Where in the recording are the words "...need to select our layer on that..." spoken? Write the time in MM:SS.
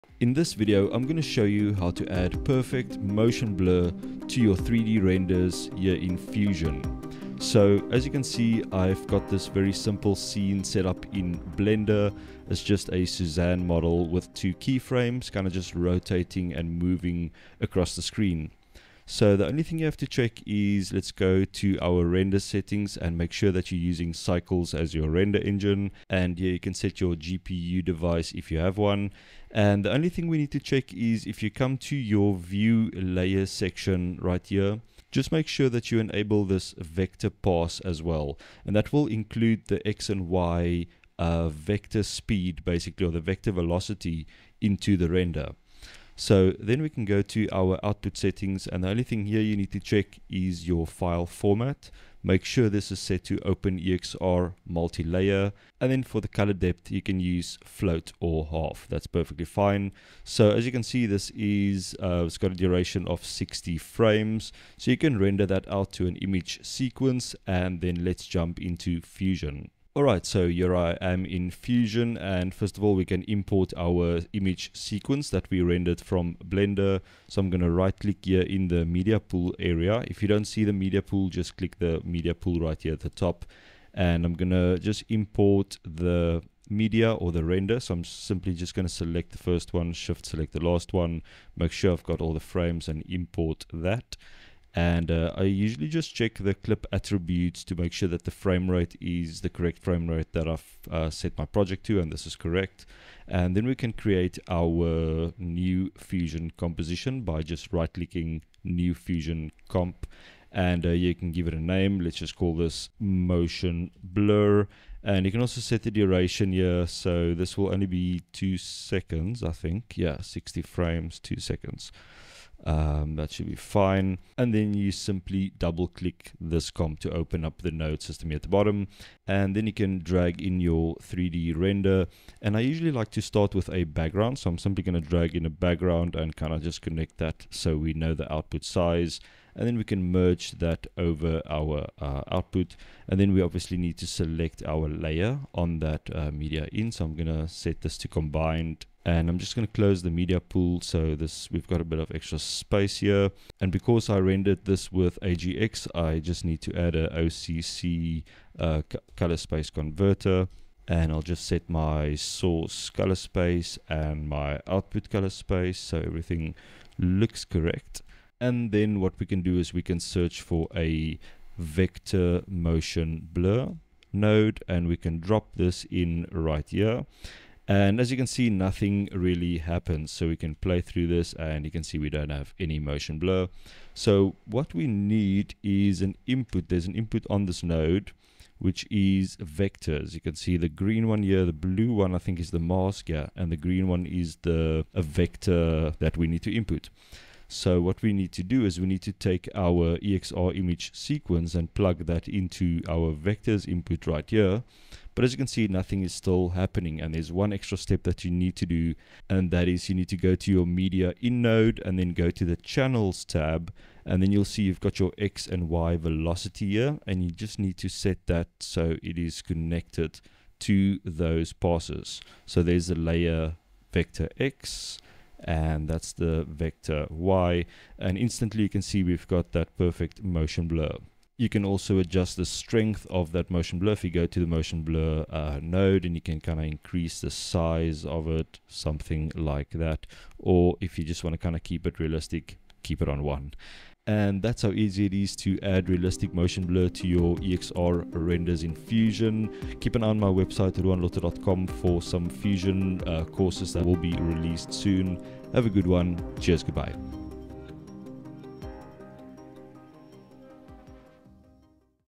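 02:23.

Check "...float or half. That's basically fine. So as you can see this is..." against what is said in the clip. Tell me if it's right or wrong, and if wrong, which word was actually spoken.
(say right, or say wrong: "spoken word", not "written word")
wrong: "perfectly", not "basically".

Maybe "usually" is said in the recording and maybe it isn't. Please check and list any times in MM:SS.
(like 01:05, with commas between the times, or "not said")
01:35, 02:12.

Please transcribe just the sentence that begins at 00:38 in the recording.
And that will include the X and Y uh, vector speed basically or the vector velocity into the render.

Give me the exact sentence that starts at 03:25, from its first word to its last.
But as you can see, nothing is still happening.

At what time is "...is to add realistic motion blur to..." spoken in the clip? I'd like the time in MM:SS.
04:05.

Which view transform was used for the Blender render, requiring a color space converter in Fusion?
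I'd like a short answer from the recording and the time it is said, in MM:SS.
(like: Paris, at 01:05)
AGX, at 02:35.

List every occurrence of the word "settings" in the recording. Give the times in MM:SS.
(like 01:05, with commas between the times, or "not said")
00:22, 00:48.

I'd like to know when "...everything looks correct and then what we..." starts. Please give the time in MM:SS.
02:45.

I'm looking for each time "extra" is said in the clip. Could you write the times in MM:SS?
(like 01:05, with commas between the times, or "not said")
02:32, 03:27.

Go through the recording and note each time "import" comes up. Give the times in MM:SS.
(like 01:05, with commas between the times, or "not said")
01:13, 01:25, 01:33.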